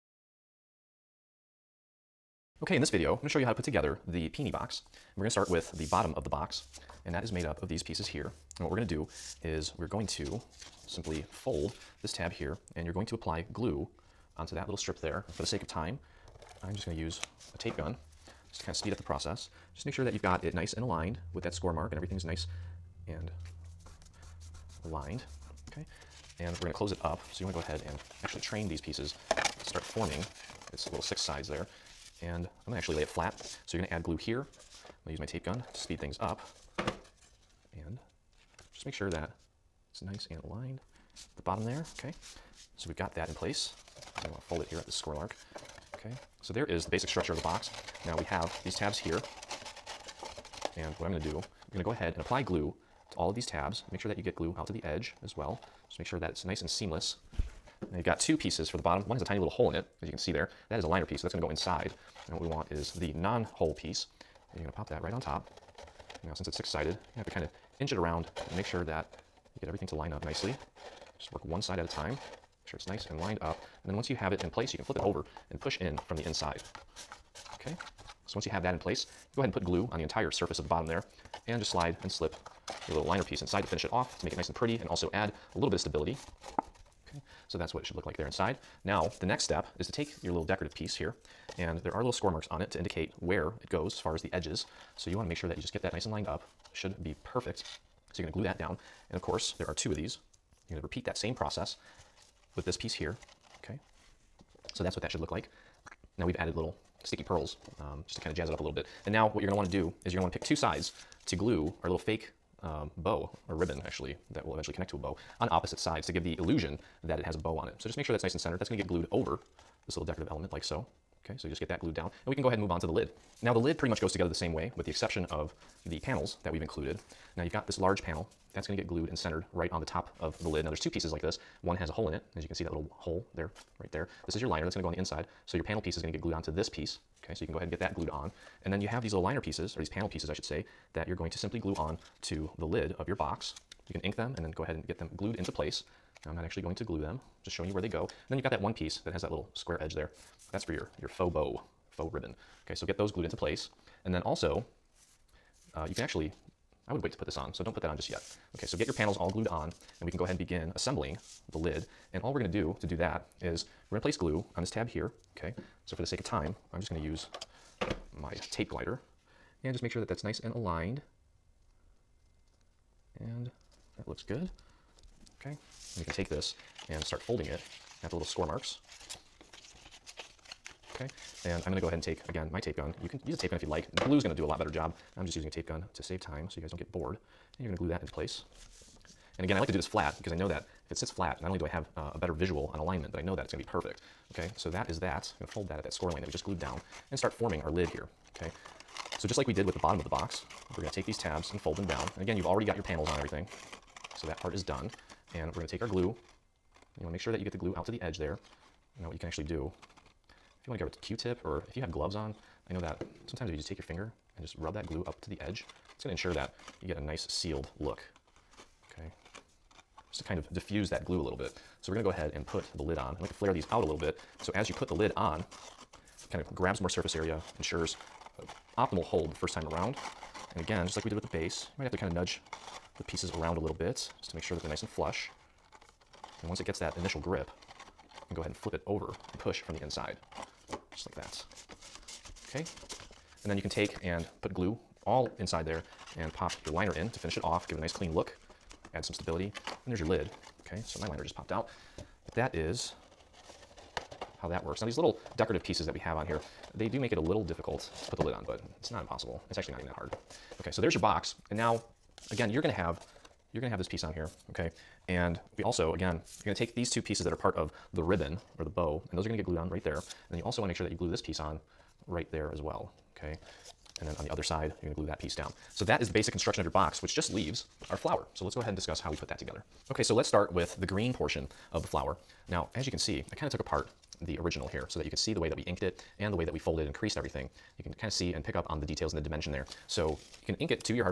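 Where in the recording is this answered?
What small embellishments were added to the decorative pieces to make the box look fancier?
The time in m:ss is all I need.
1:47.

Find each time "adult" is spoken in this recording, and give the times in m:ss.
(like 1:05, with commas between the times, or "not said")
not said.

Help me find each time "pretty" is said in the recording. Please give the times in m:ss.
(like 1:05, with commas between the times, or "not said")
1:24, 2:03.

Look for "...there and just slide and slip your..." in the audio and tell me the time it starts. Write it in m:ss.
1:20.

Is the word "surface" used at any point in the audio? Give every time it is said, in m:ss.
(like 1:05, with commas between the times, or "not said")
1:20, 3:46.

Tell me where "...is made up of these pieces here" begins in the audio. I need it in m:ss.
0:07.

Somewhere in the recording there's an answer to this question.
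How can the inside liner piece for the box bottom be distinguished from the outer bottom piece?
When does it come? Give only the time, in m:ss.
0:59.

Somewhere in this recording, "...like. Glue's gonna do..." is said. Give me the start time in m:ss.
3:03.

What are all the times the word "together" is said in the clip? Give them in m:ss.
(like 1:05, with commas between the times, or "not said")
0:03, 2:04, 4:39.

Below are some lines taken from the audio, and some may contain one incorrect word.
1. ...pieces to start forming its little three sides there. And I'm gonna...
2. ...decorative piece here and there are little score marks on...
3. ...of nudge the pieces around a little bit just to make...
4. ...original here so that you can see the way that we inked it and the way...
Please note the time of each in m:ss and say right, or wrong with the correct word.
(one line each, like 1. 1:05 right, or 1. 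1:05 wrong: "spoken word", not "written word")
1. 0:28 wrong: "six", not "three"
2. 1:30 right
3. 3:52 right
4. 4:44 right.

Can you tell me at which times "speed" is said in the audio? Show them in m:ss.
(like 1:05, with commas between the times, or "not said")
0:18, 0:35.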